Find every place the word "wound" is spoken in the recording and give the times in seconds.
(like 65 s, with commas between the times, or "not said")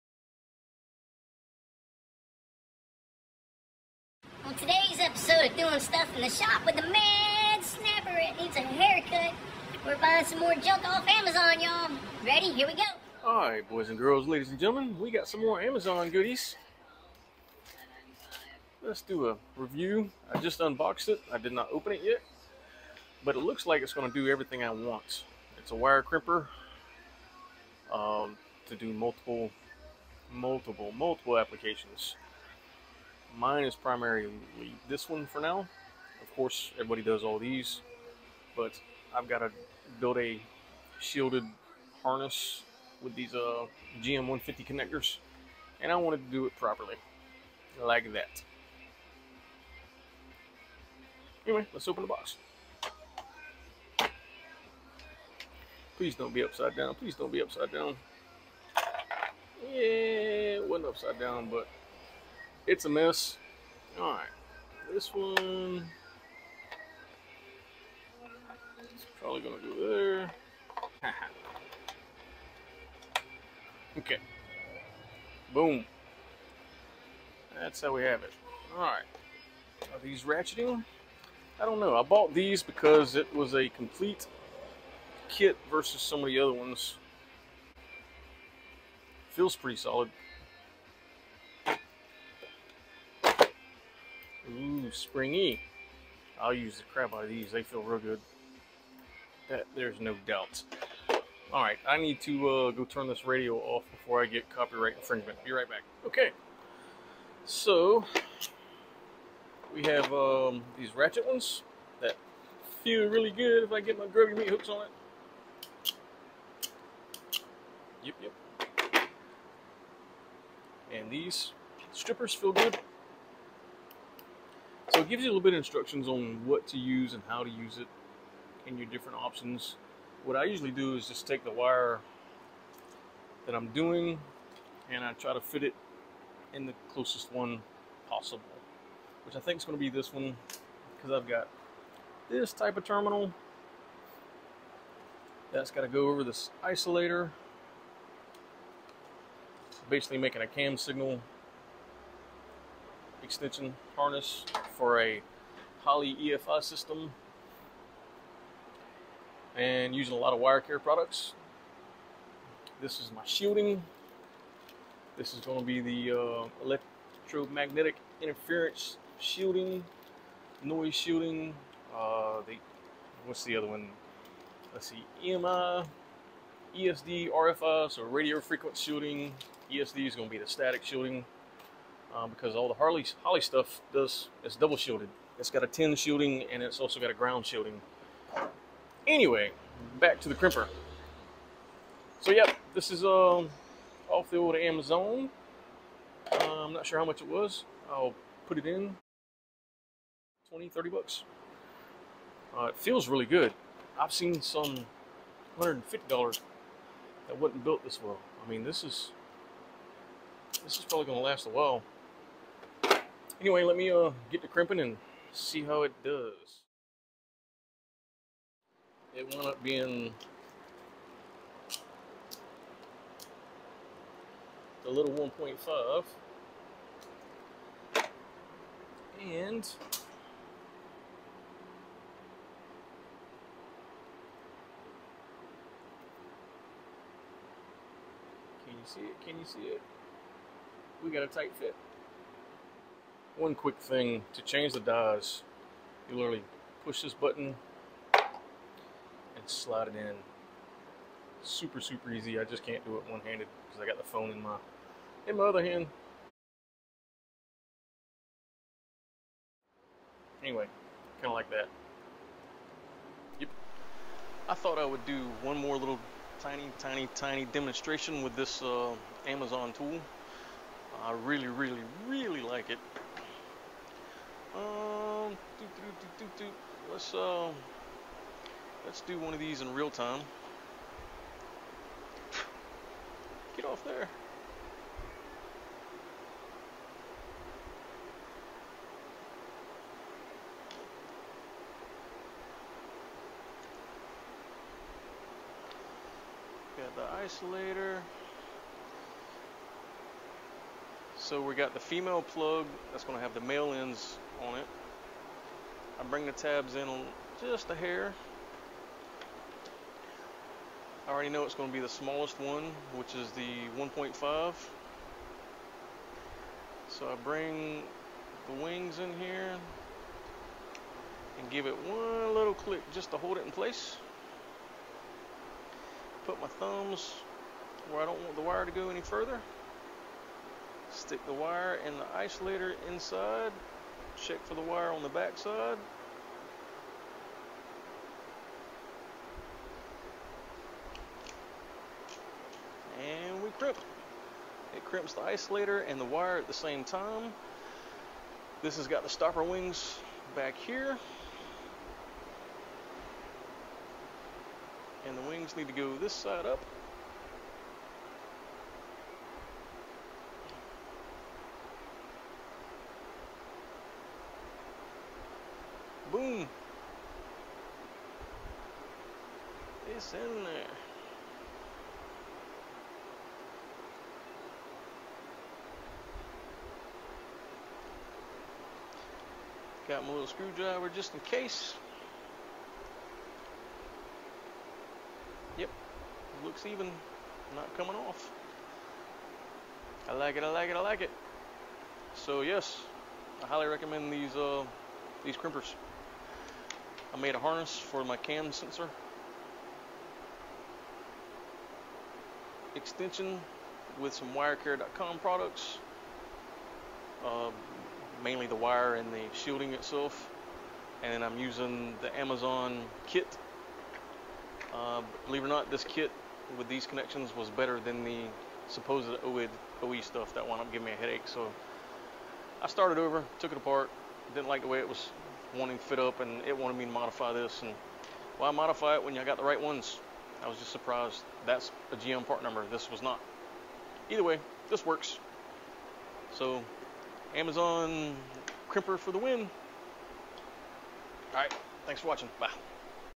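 219 s, 420 s.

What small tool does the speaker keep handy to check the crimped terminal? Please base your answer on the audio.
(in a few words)
screwdriver.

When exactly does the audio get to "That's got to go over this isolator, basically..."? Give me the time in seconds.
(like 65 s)
145 s.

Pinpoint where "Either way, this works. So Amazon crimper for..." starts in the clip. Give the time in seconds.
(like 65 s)
434 s.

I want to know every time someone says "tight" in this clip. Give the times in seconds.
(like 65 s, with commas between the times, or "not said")
241 s.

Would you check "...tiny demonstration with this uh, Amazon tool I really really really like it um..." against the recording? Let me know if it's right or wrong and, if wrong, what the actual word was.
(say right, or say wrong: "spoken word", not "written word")
right.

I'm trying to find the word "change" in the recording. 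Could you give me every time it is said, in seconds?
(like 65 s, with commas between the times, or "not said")
244 s.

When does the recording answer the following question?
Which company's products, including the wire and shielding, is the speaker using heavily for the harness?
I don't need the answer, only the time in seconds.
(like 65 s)
160 s.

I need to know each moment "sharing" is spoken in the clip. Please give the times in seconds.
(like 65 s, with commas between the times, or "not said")
not said.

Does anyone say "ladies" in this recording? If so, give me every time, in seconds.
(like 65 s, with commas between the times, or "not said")
14 s.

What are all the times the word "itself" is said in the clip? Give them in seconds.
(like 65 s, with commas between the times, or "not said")
409 s.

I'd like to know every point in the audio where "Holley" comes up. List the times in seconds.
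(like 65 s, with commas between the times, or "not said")
155 s, 183 s.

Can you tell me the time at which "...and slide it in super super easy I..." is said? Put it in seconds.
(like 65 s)
248 s.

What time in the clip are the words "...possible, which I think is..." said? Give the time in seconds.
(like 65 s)
138 s.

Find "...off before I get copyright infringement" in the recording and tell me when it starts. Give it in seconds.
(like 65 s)
103 s.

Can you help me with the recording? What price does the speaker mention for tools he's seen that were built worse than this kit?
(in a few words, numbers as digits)
$150.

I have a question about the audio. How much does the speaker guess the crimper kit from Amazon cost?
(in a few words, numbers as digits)
20, 30 bucks.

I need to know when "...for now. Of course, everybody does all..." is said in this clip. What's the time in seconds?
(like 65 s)
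35 s.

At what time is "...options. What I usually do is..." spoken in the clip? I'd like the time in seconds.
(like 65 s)
129 s.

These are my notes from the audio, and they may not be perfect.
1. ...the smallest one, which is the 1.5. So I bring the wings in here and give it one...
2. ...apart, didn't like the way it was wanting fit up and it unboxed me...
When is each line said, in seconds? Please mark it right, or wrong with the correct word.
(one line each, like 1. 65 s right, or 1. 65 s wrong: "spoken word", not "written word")
1. 311 s right
2. 423 s wrong: "wanted", not "unboxed".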